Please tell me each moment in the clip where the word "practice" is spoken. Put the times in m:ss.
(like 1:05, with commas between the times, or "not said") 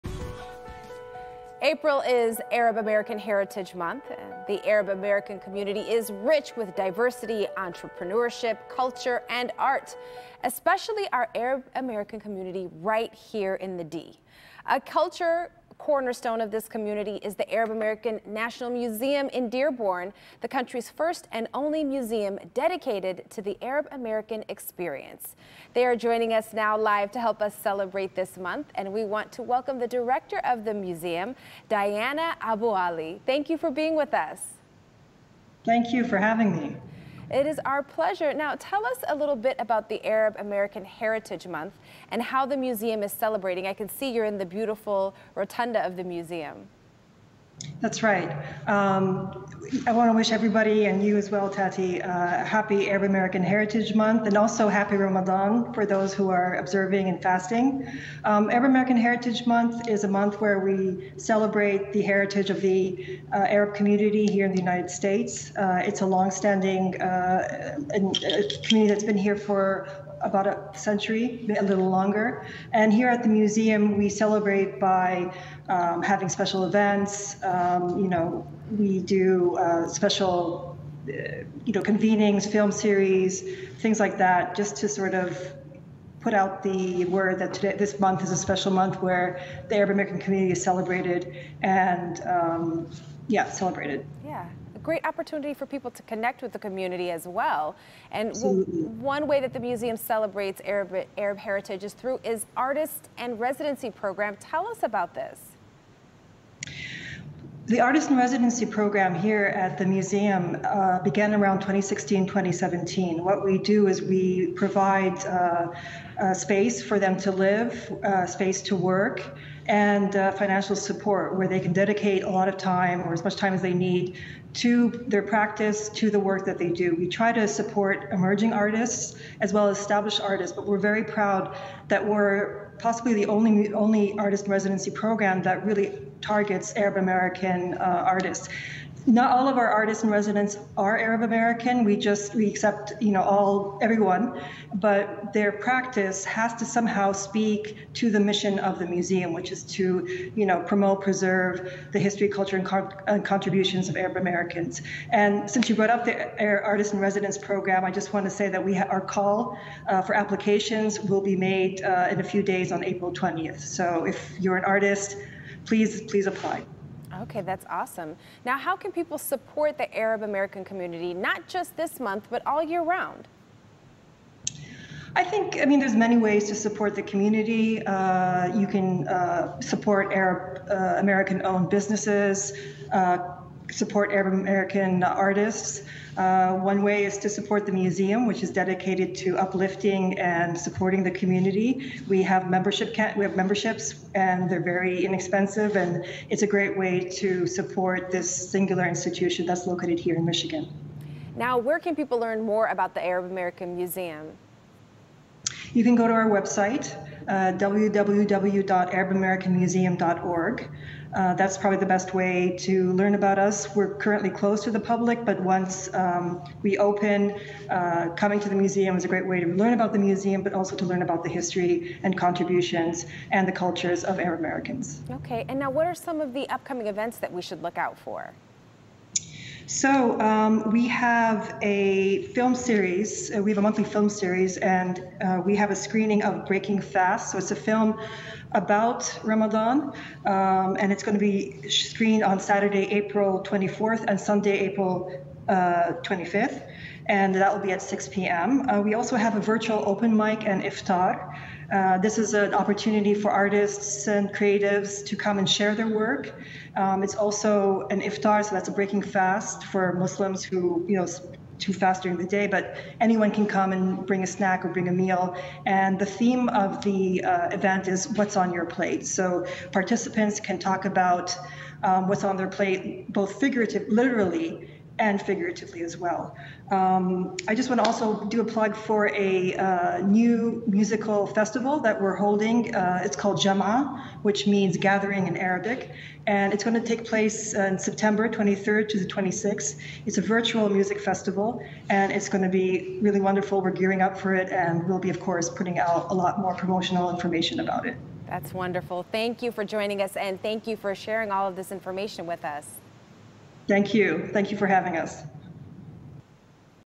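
2:05, 2:25.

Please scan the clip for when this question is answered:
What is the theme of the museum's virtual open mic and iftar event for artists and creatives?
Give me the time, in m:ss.
4:28.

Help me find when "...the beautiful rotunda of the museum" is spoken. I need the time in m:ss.
0:44.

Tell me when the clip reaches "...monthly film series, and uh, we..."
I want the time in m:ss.
3:53.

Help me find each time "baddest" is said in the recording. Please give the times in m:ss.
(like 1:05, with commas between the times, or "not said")
not said.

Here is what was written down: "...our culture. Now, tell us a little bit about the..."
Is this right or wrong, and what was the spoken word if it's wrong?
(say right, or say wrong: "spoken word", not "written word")
wrong: "pleasure", not "culture".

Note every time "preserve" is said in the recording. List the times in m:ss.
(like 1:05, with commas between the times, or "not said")
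2:31.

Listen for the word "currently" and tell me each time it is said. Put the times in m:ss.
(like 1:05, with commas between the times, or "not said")
3:33.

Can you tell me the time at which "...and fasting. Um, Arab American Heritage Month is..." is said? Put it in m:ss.
0:57.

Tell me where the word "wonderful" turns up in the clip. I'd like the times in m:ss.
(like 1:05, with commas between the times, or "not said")
4:53, 4:58.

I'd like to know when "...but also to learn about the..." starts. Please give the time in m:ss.
3:40.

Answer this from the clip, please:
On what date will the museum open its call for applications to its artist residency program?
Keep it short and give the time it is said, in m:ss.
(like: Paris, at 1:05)
April 20th, at 2:42.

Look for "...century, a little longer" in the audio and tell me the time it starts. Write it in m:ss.
1:10.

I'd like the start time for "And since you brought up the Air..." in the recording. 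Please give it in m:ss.
2:35.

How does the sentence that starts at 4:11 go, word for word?
Uh, this is an opportunity for artists and creatives to come and share their work.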